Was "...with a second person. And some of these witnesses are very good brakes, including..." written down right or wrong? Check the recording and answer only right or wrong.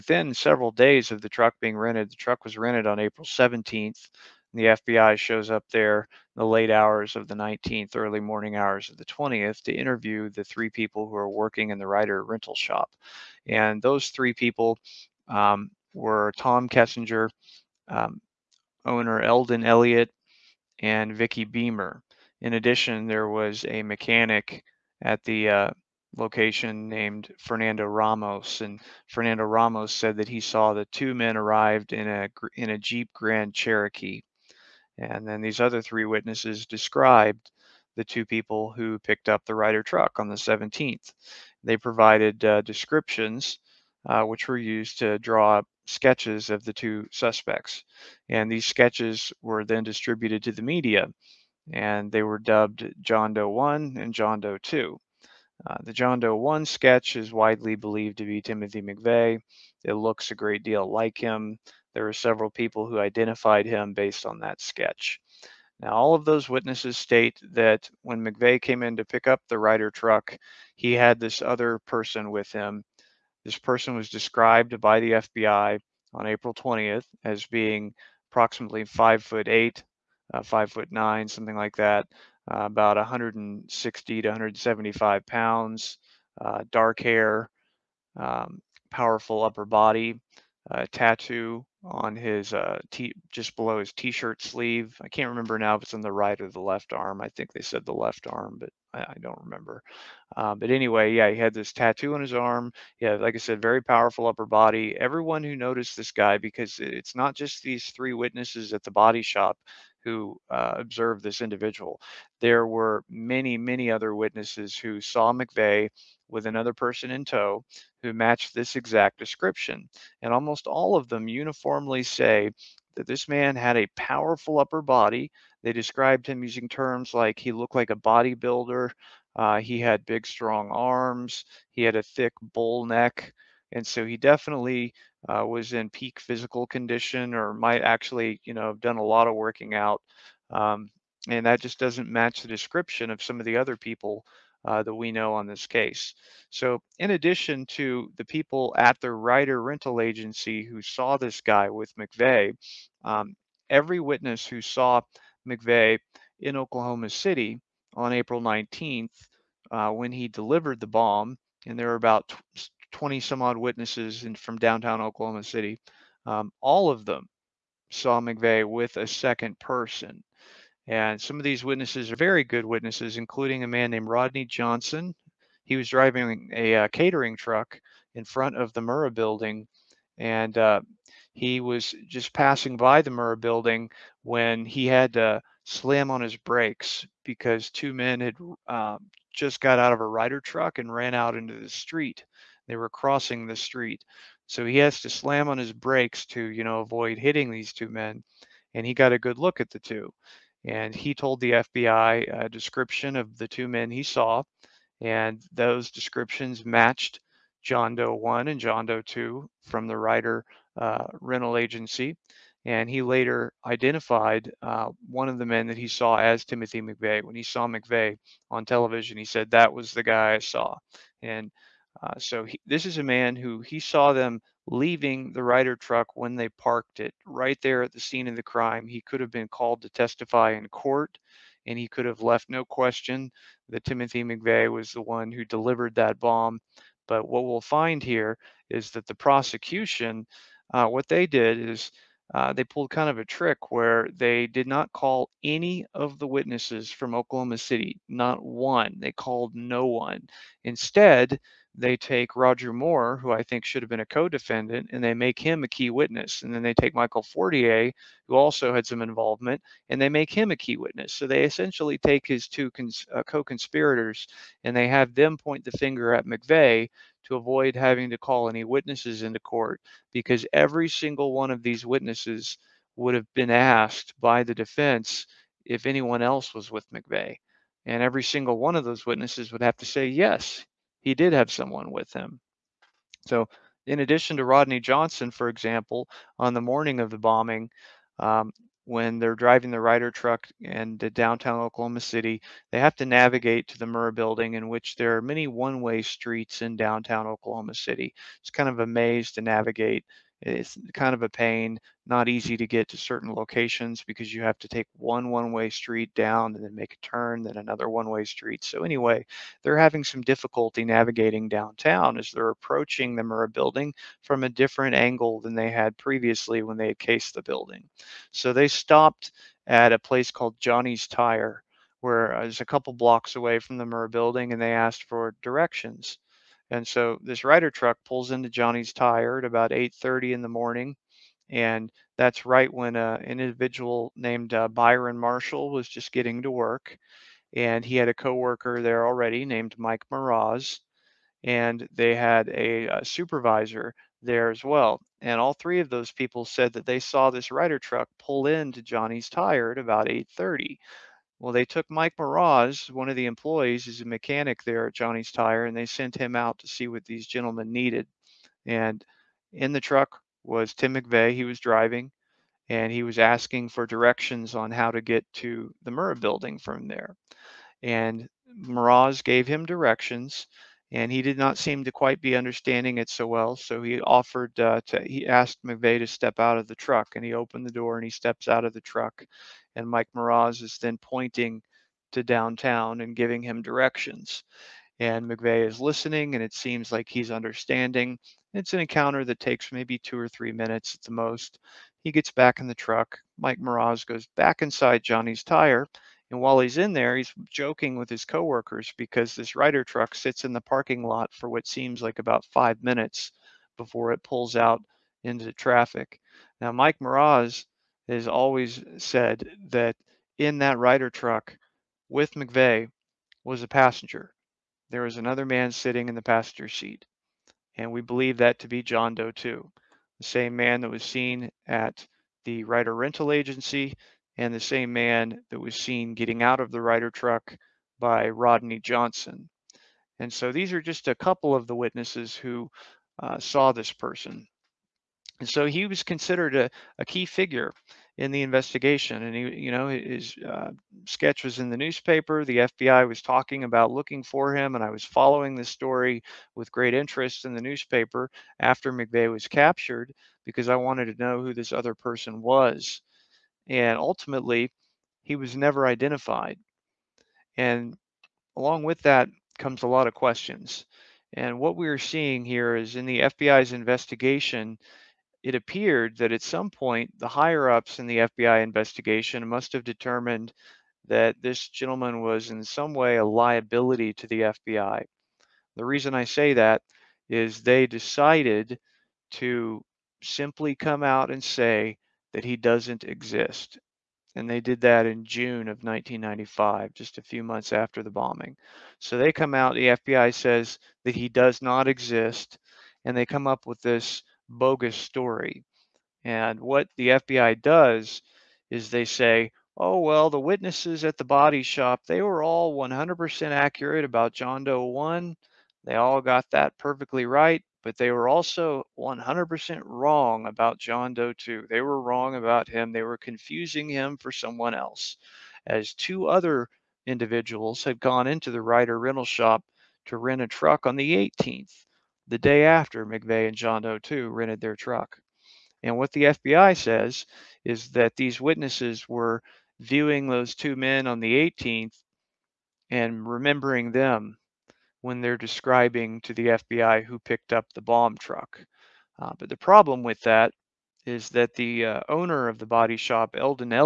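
wrong.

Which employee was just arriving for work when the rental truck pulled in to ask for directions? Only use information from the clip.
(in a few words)
Byron Marshall.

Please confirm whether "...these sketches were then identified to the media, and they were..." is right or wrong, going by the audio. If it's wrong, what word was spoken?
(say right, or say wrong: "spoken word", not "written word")
wrong: "distributed", not "identified".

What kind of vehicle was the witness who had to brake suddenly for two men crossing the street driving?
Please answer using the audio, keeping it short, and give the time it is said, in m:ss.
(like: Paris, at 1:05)
catering truck, at 2:56.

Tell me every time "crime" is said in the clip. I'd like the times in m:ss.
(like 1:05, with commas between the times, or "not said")
3:48.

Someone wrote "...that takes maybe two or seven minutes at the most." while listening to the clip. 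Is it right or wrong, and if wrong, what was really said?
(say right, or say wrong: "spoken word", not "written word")
wrong: "three", not "seven".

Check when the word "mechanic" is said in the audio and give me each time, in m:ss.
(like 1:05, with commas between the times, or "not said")
0:23, 5:54.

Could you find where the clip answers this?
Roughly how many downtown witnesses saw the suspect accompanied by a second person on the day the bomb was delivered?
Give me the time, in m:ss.
2:42.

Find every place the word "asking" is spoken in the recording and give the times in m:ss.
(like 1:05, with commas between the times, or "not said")
6:03.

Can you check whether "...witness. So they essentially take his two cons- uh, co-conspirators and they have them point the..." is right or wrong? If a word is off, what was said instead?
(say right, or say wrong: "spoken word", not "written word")
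right.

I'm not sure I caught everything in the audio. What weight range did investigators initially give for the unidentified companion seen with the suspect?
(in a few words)
160 to 175 pounds.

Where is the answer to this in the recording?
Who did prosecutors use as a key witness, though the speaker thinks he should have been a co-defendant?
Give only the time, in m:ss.
4:12.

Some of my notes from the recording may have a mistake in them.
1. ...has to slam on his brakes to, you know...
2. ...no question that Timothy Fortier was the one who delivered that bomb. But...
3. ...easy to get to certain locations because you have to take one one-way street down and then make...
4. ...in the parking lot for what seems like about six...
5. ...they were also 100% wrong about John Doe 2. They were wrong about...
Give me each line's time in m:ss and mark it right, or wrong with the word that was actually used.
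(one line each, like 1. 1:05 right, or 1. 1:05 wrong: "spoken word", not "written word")
1. 3:14 right
2. 3:52 wrong: "McVeigh", not "Fortier"
3. 5:02 right
4. 6:40 wrong: "five", not "six"
5. 8:27 right.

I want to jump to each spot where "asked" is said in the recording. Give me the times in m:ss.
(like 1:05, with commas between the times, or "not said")
4:33, 5:24, 6:15.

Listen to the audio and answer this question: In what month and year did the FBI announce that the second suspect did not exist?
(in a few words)
June 1995.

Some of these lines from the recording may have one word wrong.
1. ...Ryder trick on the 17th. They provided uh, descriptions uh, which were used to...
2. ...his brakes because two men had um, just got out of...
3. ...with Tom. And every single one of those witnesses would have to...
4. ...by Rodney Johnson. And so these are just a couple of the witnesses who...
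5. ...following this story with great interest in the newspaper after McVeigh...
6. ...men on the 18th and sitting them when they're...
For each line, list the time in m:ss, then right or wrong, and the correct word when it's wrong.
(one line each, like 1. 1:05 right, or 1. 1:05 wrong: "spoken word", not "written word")
1. 0:39 wrong: "truck", not "trick"
2. 3:06 right
3. 4:36 wrong: "McVeigh", not "Tom"
4. 7:07 right
5. 7:25 right
6. 8:50 wrong: "remembering", not "sitting".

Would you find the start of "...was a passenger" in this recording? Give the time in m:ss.
6:53.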